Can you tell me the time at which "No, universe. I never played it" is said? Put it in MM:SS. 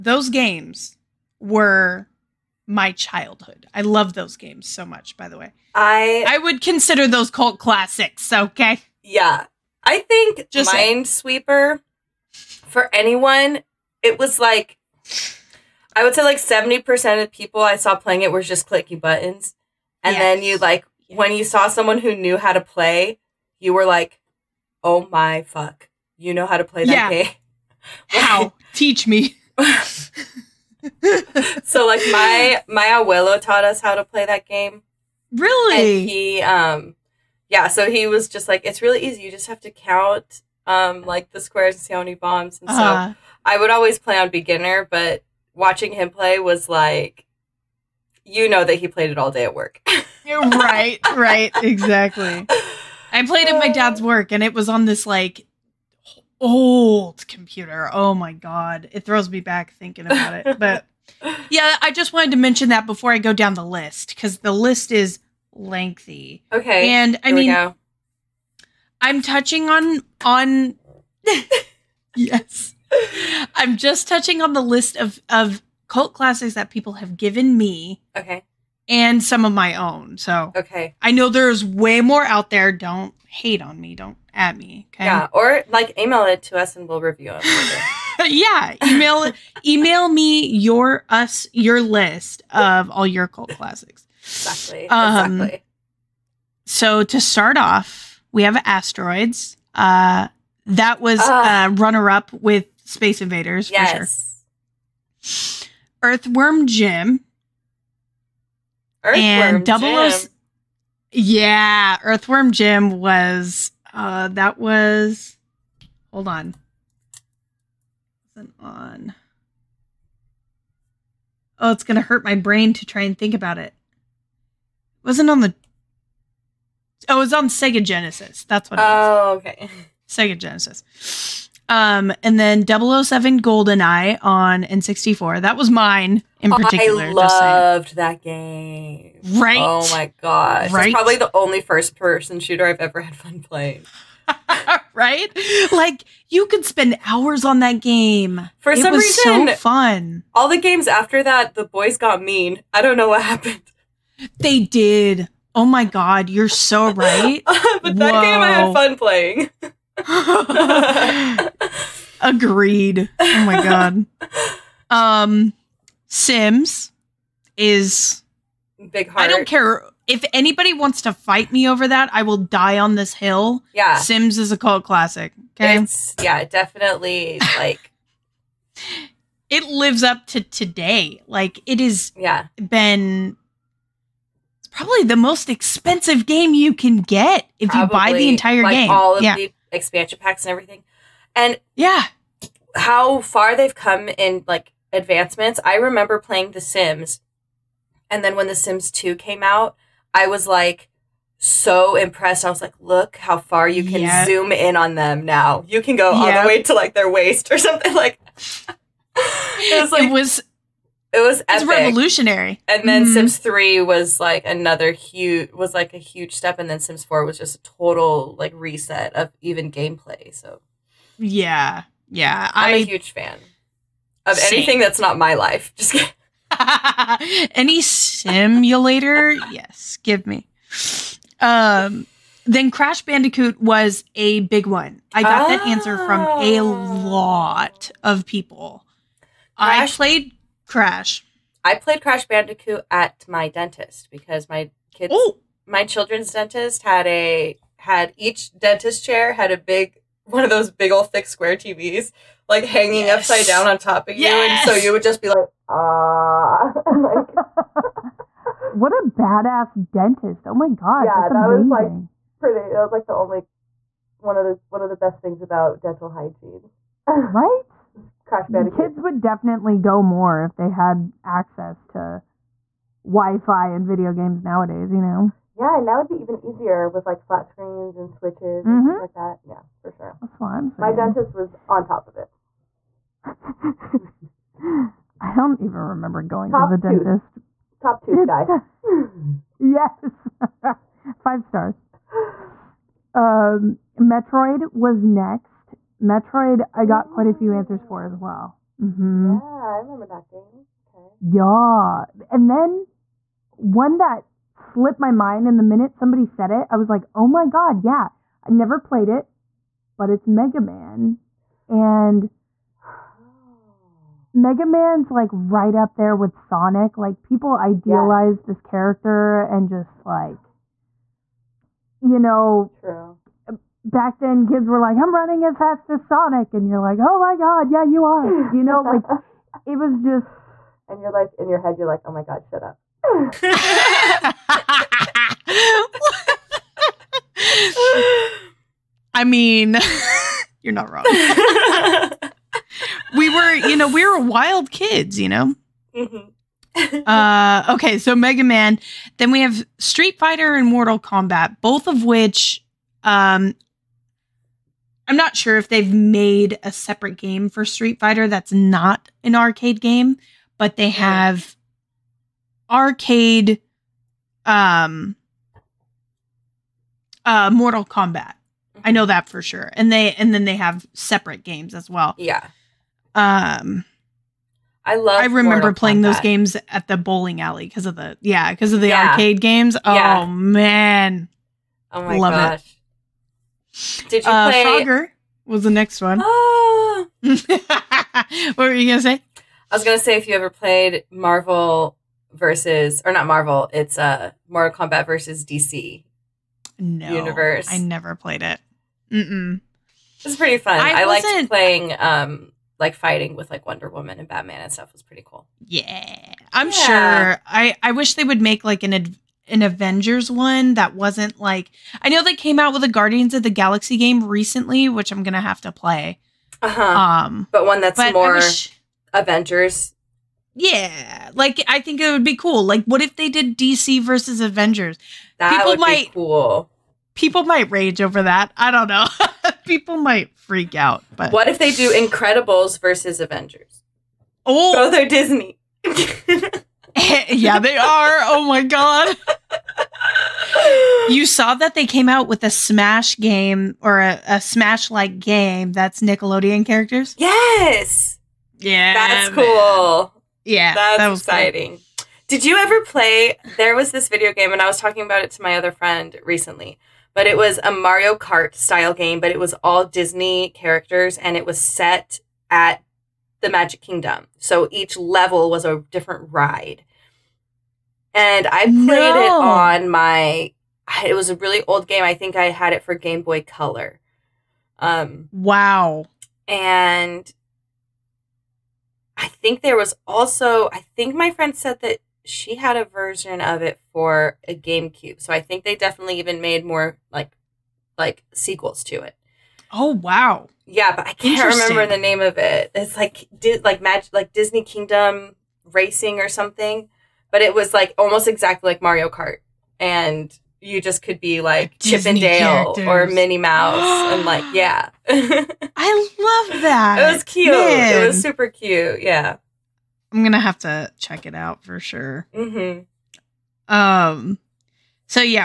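06:36.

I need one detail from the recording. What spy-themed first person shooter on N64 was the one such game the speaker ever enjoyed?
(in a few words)
007 Goldeneye.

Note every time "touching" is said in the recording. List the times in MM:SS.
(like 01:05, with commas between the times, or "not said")
01:09, 01:14.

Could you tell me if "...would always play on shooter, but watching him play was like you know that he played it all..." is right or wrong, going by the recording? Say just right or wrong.
wrong.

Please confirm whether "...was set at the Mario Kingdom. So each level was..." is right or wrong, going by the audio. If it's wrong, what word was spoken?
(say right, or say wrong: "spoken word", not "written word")
wrong: "Magic", not "Mario".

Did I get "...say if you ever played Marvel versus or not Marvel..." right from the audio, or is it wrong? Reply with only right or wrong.
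right.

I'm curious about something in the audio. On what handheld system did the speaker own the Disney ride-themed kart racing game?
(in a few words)
Game Boy Color.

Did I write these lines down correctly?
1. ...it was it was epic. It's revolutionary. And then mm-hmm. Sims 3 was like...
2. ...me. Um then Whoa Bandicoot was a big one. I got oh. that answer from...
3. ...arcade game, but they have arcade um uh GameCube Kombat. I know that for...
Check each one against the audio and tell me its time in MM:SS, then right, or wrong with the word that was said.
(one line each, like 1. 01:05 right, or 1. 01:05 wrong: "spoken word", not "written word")
1. 03:30 right
2. 03:50 wrong: "Crash", not "Whoa"
3. 05:59 wrong: "Mortal", not "GameCube".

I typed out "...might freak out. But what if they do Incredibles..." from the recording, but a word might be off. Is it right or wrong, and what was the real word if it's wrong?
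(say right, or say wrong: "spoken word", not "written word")
right.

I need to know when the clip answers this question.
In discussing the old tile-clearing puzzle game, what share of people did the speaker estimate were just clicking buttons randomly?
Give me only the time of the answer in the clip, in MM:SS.
00:16.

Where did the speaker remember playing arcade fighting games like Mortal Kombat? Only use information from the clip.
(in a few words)
bowling alley.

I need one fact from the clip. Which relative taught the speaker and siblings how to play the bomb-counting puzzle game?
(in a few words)
abuelo.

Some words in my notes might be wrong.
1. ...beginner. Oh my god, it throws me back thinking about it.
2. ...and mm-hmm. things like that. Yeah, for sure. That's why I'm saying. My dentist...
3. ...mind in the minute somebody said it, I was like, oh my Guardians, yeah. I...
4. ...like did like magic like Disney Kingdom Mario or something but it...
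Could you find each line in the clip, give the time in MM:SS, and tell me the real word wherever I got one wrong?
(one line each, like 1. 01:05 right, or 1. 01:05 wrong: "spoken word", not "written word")
1. 00:57 wrong: "computer", not "beginner"
2. 04:38 right
3. 05:05 wrong: "God", not "Guardians"
4. 08:12 wrong: "Racing", not "Mario".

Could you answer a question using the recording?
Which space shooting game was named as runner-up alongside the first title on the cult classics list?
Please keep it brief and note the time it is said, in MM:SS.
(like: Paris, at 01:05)
Space Invaders, at 01:42.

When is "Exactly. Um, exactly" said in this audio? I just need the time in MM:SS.
01:34.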